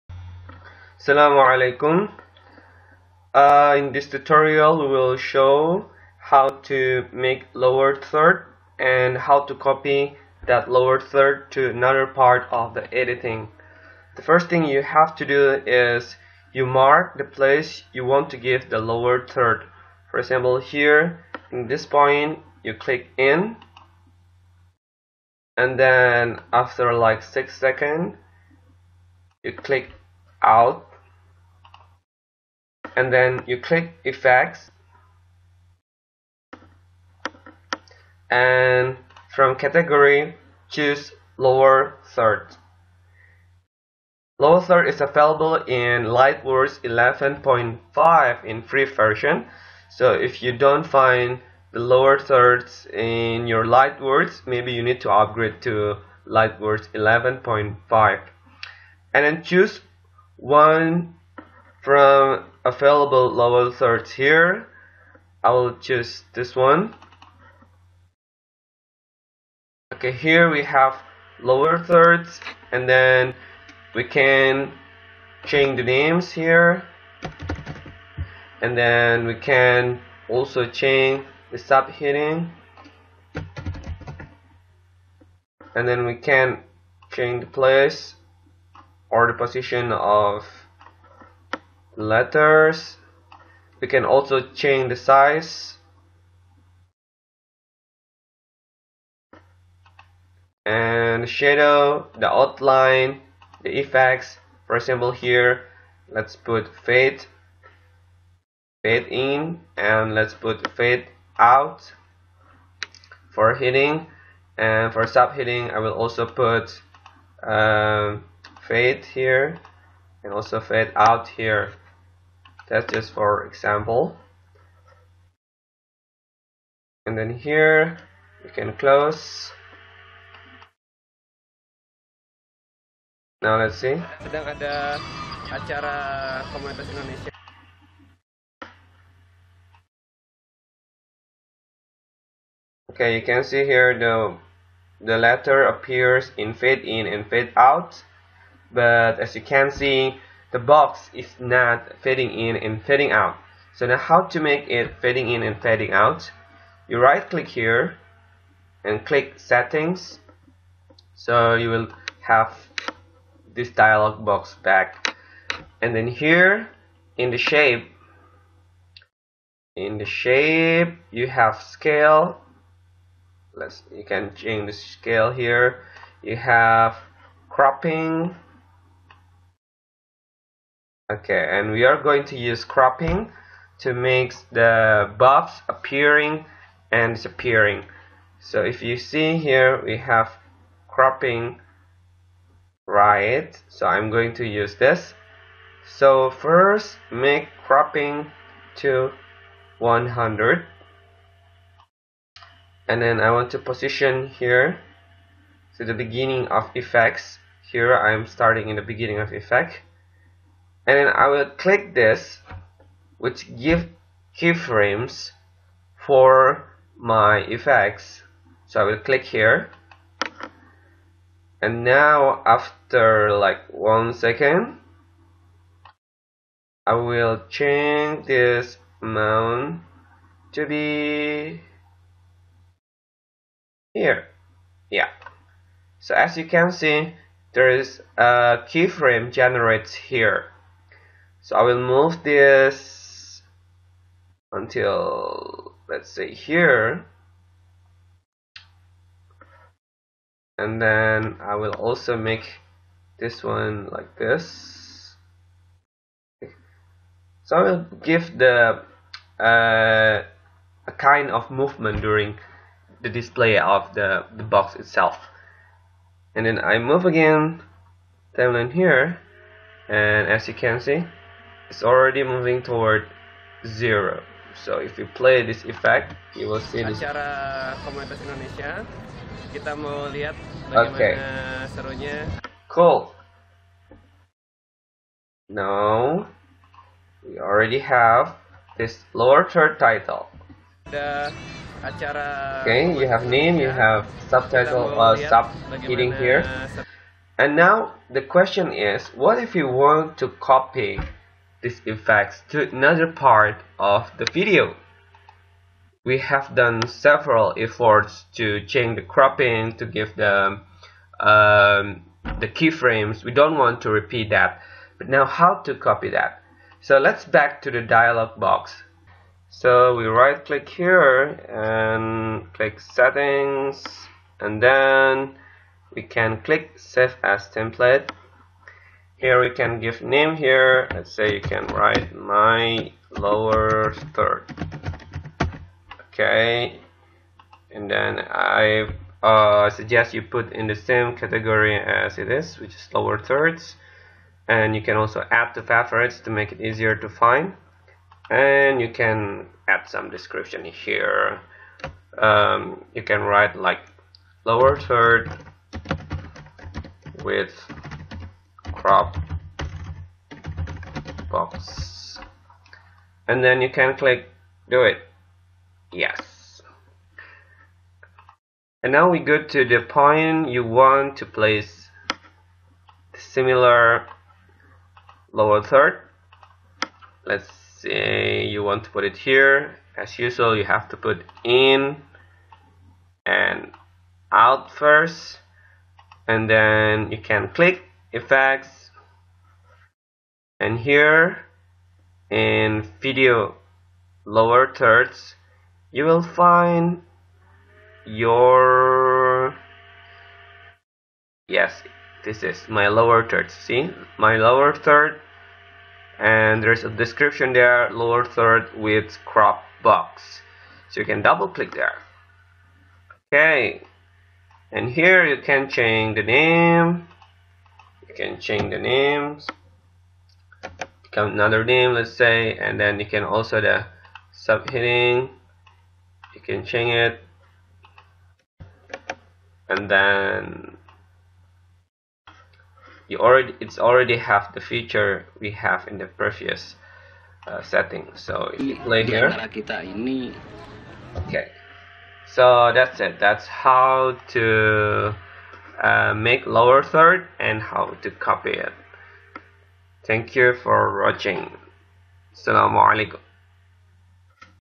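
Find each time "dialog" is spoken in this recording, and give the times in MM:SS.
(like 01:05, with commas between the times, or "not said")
02:43, 05:17.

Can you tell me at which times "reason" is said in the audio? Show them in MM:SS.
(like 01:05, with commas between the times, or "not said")
not said.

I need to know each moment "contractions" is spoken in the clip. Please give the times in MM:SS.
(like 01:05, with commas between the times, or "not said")
not said.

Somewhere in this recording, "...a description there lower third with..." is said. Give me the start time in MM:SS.
06:46.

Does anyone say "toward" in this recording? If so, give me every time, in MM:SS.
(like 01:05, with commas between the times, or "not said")
04:32.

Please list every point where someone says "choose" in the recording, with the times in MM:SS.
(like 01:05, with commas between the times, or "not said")
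00:40, 00:59, 01:05.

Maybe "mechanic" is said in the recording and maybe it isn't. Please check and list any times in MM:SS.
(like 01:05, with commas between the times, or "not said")
not said.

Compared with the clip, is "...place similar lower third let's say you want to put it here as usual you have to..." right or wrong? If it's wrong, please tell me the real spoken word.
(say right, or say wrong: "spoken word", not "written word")
right.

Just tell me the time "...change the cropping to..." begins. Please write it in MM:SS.
05:08.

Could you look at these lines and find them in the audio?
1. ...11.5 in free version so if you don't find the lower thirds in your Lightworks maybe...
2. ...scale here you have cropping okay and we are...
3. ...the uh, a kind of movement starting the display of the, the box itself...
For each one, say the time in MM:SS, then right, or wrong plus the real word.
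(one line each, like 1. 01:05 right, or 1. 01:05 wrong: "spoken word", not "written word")
1. 00:46 right
2. 02:54 right
3. 04:18 wrong: "during", not "starting".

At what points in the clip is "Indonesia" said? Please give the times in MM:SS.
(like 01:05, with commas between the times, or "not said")
02:16, 04:38.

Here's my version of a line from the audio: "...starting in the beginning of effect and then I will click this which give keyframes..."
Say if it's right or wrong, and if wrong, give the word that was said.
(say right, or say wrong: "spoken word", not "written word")
right.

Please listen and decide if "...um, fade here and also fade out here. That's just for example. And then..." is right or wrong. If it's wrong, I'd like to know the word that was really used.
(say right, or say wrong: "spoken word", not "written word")
right.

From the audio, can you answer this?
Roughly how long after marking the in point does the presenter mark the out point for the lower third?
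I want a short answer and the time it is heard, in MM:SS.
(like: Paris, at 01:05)
6 seconds, at 00:27.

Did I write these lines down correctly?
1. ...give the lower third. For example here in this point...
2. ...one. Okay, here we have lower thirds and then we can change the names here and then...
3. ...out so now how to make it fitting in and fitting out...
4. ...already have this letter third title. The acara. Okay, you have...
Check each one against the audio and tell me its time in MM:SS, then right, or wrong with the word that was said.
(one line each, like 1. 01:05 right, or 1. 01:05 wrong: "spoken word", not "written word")
1. 00:18 right
2. 01:06 right
3. 02:33 right
4. 04:47 wrong: "lower", not "letter".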